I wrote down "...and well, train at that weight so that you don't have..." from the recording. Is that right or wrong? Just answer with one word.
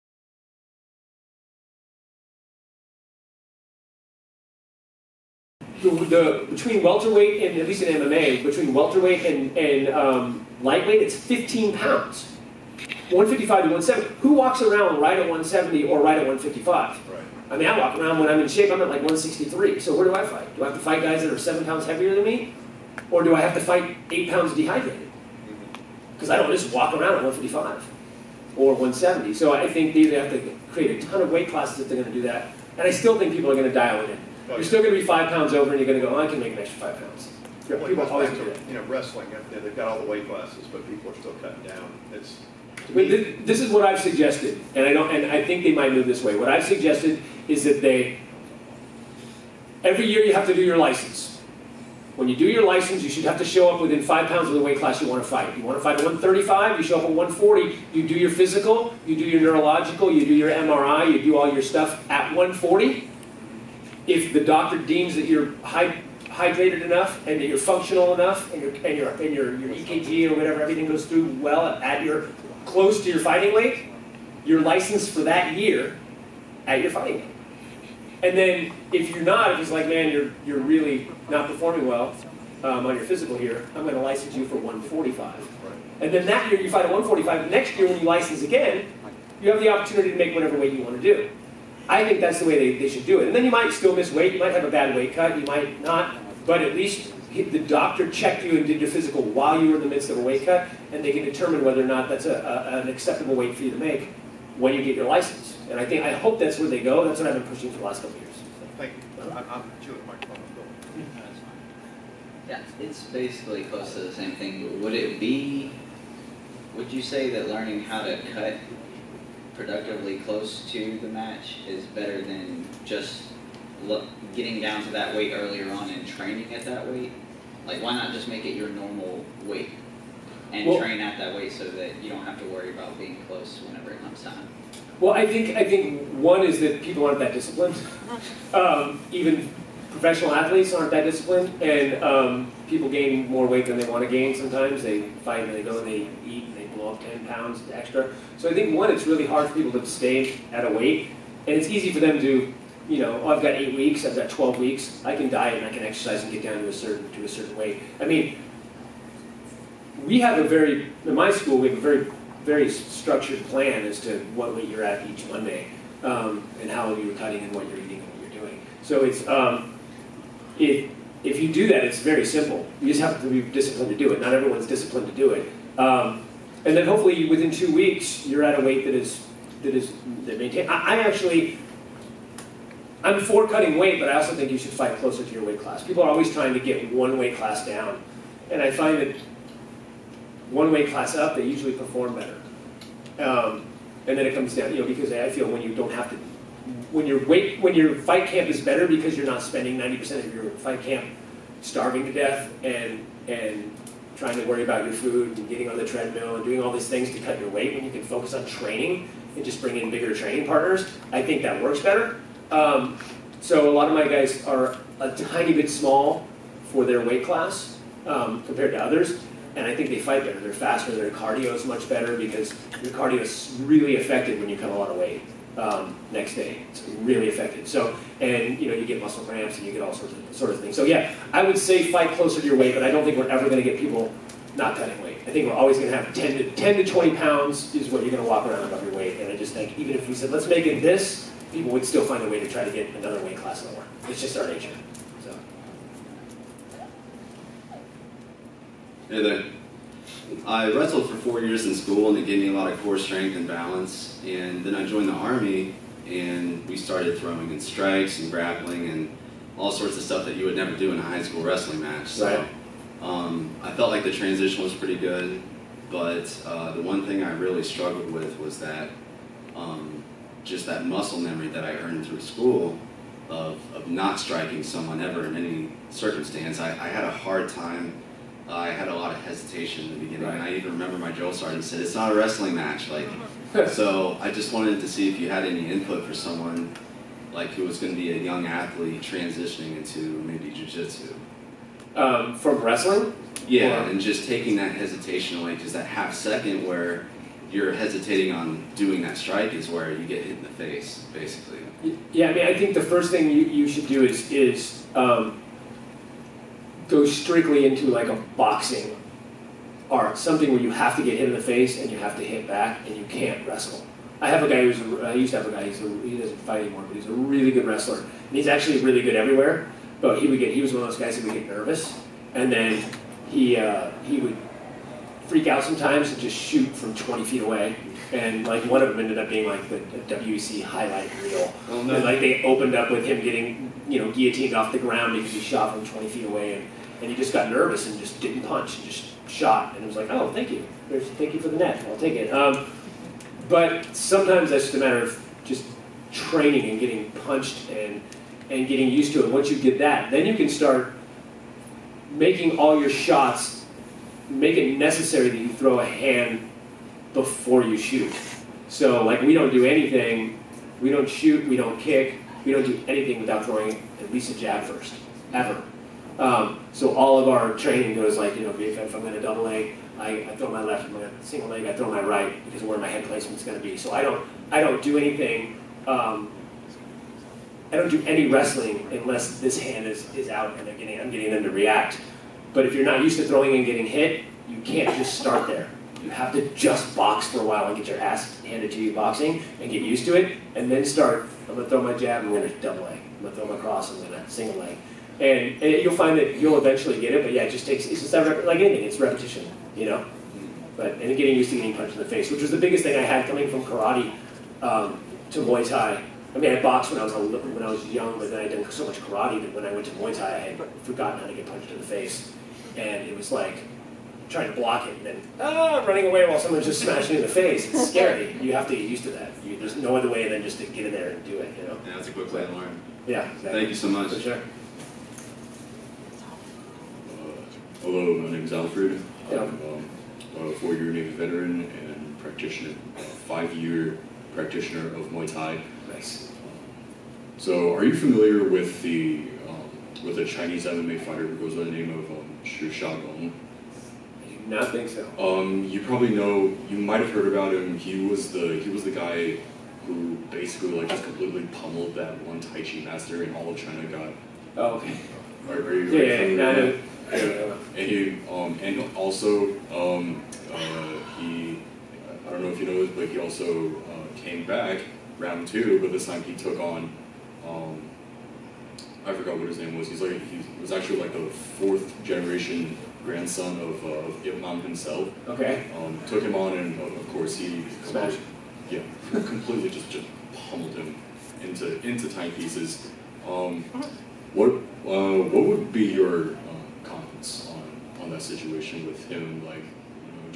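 right.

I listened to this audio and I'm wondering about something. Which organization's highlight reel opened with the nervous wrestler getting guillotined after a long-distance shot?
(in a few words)
WEC.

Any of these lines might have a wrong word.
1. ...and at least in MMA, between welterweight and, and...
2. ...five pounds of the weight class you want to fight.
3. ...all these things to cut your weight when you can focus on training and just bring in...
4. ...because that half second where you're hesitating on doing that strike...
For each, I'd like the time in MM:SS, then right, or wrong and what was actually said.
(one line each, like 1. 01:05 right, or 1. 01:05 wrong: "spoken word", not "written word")
1. 00:07 right
2. 00:54 right
3. 03:26 right
4. 04:55 right.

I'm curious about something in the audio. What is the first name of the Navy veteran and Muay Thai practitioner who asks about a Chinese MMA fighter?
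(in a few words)
Alfred.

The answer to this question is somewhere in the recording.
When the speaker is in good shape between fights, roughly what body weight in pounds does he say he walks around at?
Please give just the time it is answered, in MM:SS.
00:19.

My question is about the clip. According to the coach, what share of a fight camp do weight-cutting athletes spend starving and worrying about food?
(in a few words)
90%.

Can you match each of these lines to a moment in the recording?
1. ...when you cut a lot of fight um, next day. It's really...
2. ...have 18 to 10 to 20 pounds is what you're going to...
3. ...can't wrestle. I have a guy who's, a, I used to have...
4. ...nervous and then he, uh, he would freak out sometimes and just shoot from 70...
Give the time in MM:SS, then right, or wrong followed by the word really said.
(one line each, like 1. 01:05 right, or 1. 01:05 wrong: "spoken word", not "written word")
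1. 03:44 wrong: "weight", not "fight"
2. 03:55 wrong: "10", not "18"
3. 05:13 right
4. 05:21 wrong: "20", not "70".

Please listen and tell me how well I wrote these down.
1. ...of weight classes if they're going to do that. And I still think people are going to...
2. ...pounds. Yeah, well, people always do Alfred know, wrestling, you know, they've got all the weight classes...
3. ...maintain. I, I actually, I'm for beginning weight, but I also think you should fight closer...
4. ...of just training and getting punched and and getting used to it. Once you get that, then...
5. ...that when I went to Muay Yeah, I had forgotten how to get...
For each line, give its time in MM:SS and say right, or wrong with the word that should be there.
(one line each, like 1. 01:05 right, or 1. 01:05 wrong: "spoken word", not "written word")
1. 00:31 right
2. 00:36 wrong: "You", not "Alfred"
3. 03:00 wrong: "cutting", not "beginning"
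4. 05:45 right
5. 06:49 wrong: "Thai", not "Yeah".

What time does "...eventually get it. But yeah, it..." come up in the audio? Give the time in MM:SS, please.
06:36.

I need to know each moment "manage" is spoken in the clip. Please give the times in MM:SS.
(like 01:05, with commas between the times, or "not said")
not said.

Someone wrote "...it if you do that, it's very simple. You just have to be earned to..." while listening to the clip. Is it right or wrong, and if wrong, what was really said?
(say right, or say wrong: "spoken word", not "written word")
wrong: "disciplined", not "earned".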